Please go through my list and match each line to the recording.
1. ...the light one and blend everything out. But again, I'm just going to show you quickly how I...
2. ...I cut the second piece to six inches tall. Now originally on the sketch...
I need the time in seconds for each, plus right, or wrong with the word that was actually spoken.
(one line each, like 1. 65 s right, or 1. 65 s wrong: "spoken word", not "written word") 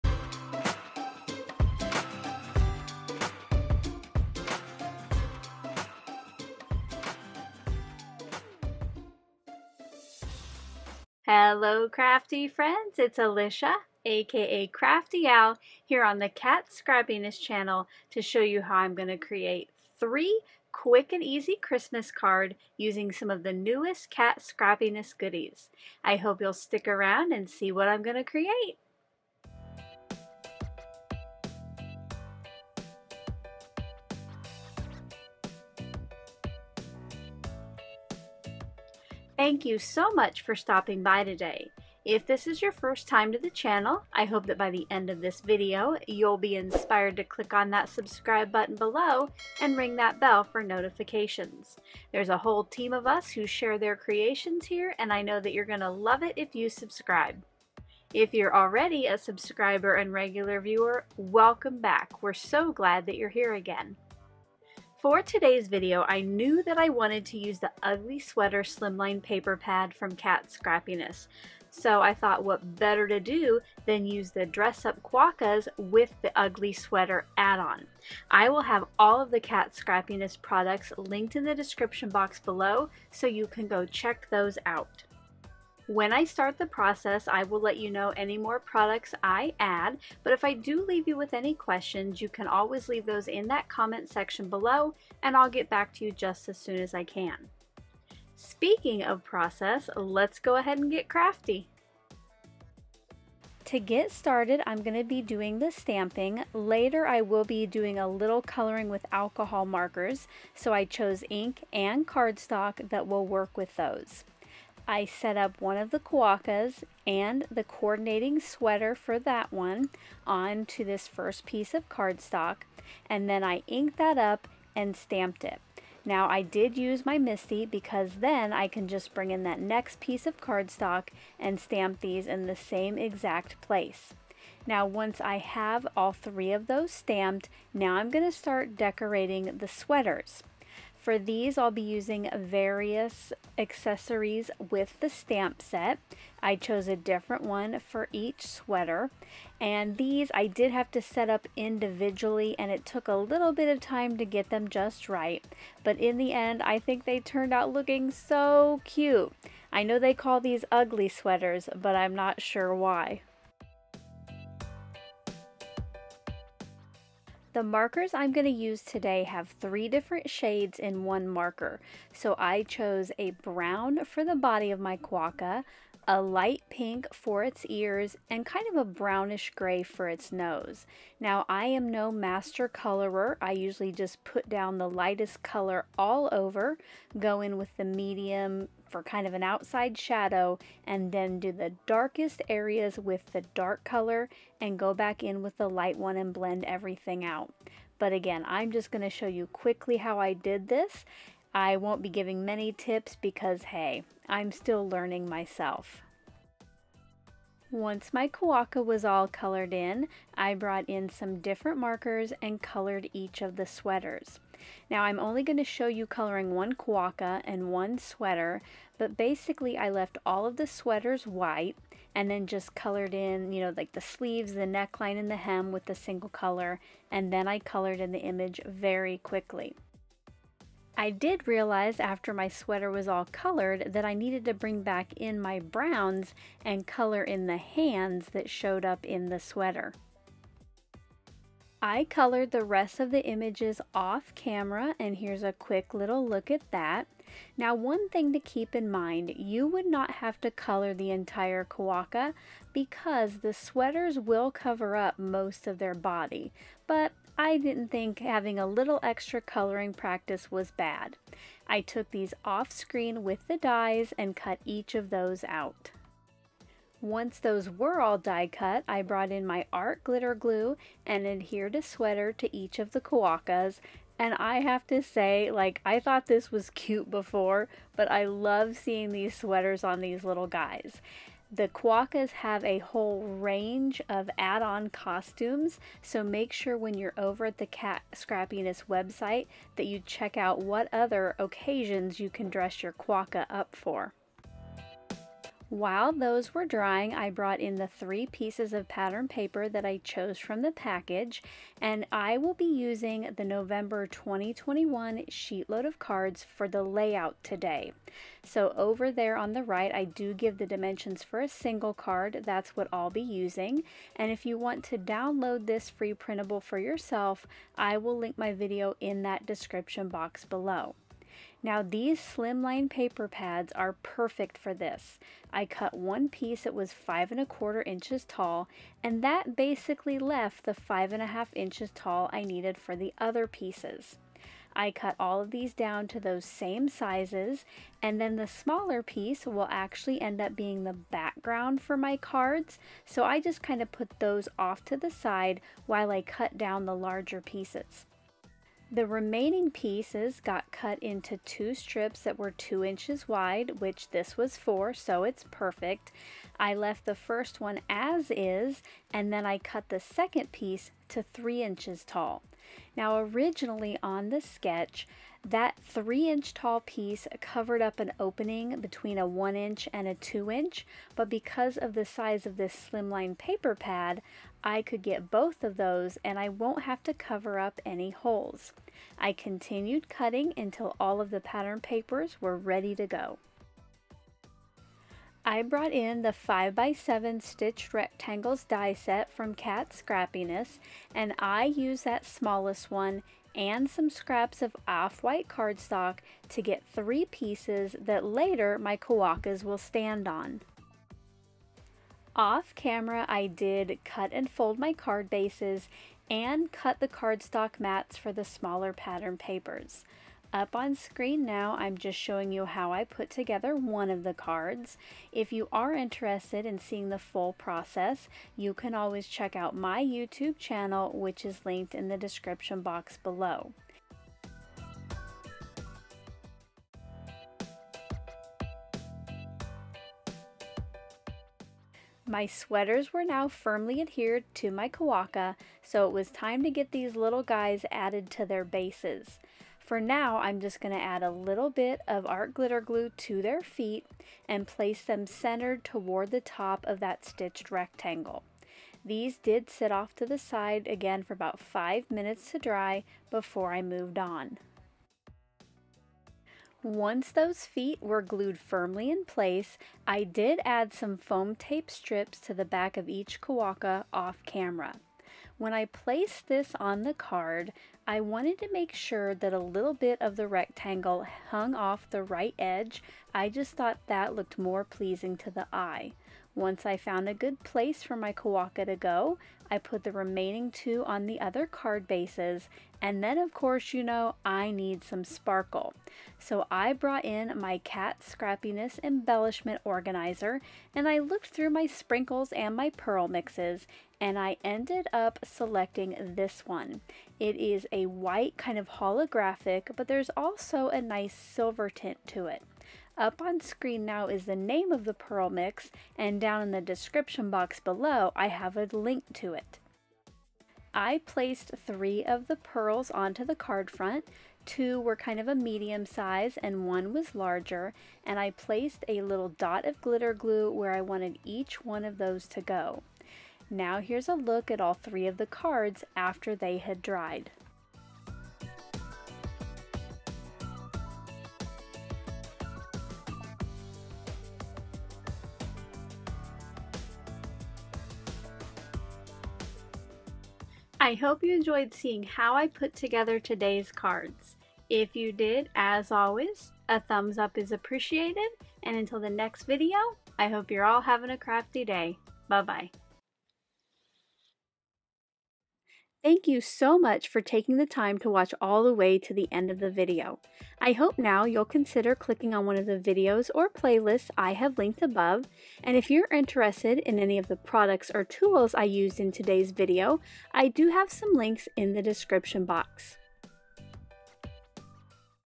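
1. 195 s right
2. 359 s wrong: "three", not "six".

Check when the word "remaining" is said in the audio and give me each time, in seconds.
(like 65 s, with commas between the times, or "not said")
349 s, 480 s.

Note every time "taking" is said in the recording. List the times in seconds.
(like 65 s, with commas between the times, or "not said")
557 s.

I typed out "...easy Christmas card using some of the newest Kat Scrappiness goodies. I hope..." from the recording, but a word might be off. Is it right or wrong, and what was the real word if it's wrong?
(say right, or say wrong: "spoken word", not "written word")
right.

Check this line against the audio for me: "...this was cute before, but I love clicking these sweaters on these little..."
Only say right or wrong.
wrong.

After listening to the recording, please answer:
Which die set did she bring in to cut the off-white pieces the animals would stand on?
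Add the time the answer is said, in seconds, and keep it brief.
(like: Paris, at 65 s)
5x7 stitched rectangles, at 386 s.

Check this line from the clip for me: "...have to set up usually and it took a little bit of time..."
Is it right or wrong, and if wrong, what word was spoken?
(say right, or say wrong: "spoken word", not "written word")
wrong: "individually", not "usually".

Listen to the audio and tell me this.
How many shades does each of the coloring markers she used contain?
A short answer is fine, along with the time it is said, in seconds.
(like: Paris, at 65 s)
3, at 169 s.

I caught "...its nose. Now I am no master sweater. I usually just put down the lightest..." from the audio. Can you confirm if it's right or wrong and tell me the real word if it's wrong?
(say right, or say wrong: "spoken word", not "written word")
wrong: "colorer", not "sweater".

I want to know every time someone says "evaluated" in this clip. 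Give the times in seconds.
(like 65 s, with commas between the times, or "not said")
not said.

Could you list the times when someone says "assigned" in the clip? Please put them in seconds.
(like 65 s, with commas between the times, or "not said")
not said.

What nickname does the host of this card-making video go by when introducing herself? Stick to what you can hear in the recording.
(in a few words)
Crafty Al.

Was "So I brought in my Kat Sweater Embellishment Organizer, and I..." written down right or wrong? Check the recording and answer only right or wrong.
wrong.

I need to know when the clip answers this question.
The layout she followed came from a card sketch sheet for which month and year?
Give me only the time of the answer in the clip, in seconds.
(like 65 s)
303 s.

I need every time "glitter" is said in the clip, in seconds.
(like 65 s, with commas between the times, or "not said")
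270 s, 442 s, 519 s.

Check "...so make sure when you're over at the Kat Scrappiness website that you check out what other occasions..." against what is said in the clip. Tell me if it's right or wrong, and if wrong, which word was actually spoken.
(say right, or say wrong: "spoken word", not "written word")
right.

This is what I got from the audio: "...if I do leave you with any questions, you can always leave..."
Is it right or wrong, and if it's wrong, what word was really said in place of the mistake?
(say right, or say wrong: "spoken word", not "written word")
right.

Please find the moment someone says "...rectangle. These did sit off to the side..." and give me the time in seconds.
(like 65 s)
447 s.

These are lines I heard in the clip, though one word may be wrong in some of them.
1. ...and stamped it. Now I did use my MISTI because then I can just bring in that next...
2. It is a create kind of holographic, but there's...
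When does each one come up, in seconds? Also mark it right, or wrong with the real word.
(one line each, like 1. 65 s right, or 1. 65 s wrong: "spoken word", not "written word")
1. 124 s right
2. 497 s wrong: "white", not "create".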